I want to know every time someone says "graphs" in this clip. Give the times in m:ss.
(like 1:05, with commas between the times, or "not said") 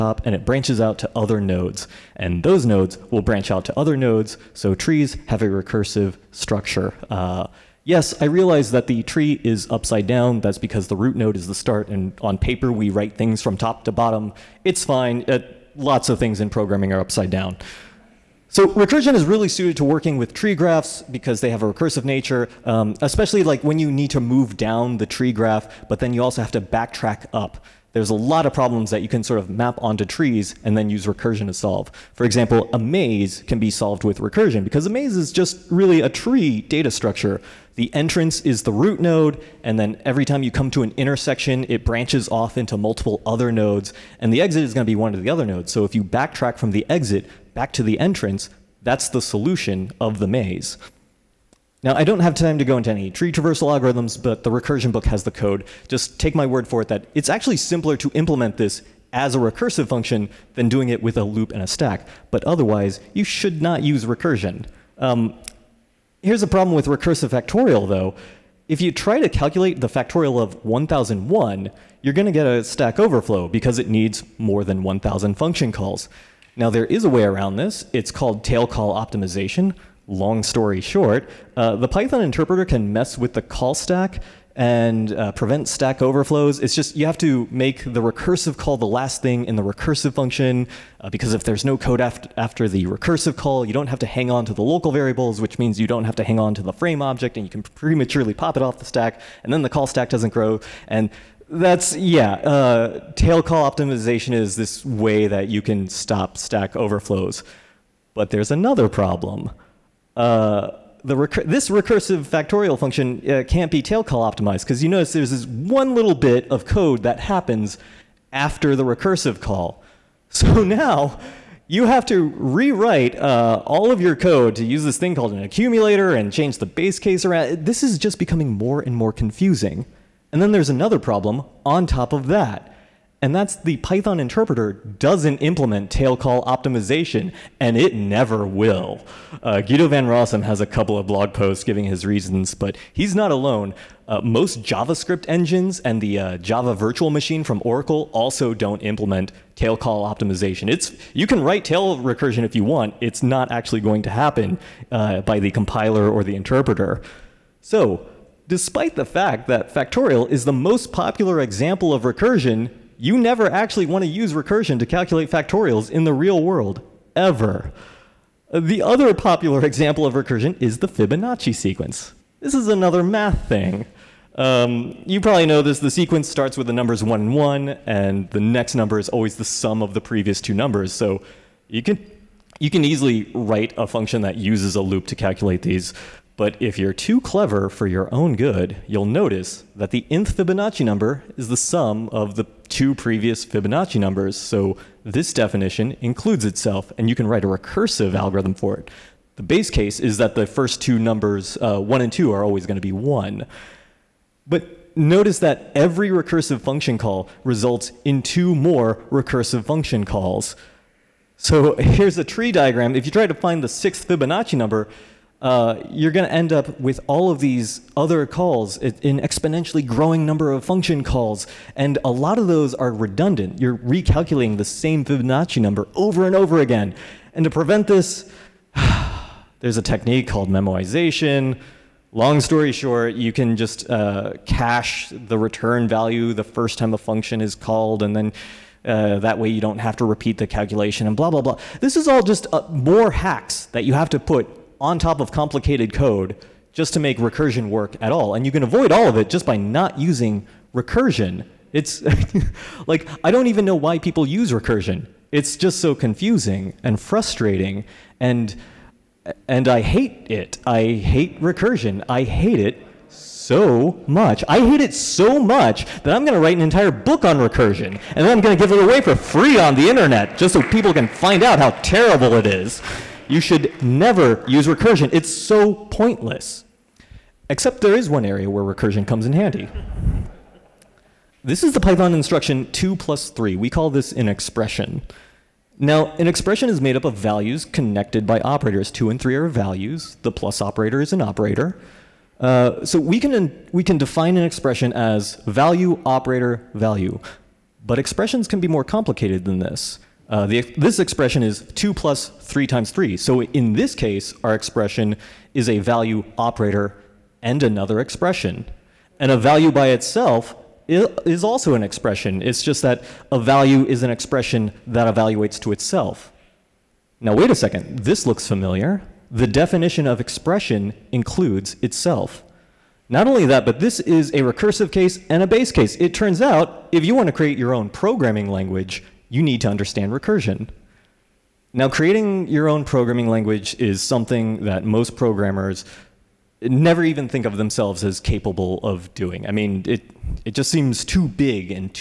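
0:20, 0:25.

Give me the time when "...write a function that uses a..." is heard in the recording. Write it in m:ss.
3:03.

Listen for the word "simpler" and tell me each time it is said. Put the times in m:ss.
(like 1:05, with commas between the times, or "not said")
0:57.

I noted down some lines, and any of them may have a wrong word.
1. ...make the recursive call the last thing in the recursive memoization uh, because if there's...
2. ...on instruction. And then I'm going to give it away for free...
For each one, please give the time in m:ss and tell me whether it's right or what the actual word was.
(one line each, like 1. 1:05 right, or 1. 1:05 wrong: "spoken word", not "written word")
1. 1:27 wrong: "function", not "memoization"
2. 4:27 wrong: "recursion", not "instruction".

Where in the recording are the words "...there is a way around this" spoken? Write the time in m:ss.
1:16.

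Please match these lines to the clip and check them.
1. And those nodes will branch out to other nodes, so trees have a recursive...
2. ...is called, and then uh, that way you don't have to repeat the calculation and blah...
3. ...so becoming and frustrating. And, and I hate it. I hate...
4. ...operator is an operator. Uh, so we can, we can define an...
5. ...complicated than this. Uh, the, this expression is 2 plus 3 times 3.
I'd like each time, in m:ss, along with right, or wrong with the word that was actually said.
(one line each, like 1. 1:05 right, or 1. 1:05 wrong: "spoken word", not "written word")
1. 0:02 right
2. 3:57 right
3. 4:15 wrong: "confusing", not "becoming"
4. 4:50 right
5. 4:58 right.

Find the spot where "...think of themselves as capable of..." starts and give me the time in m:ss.
5:37.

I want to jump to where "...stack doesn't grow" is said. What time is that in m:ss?
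1:39.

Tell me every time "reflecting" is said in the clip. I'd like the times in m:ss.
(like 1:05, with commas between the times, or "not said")
not said.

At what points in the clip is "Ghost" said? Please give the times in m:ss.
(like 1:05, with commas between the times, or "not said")
not said.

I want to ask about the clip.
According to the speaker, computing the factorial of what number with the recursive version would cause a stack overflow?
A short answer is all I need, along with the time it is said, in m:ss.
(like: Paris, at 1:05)
1001, at 1:10.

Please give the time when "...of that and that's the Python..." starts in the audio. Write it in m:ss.
2:12.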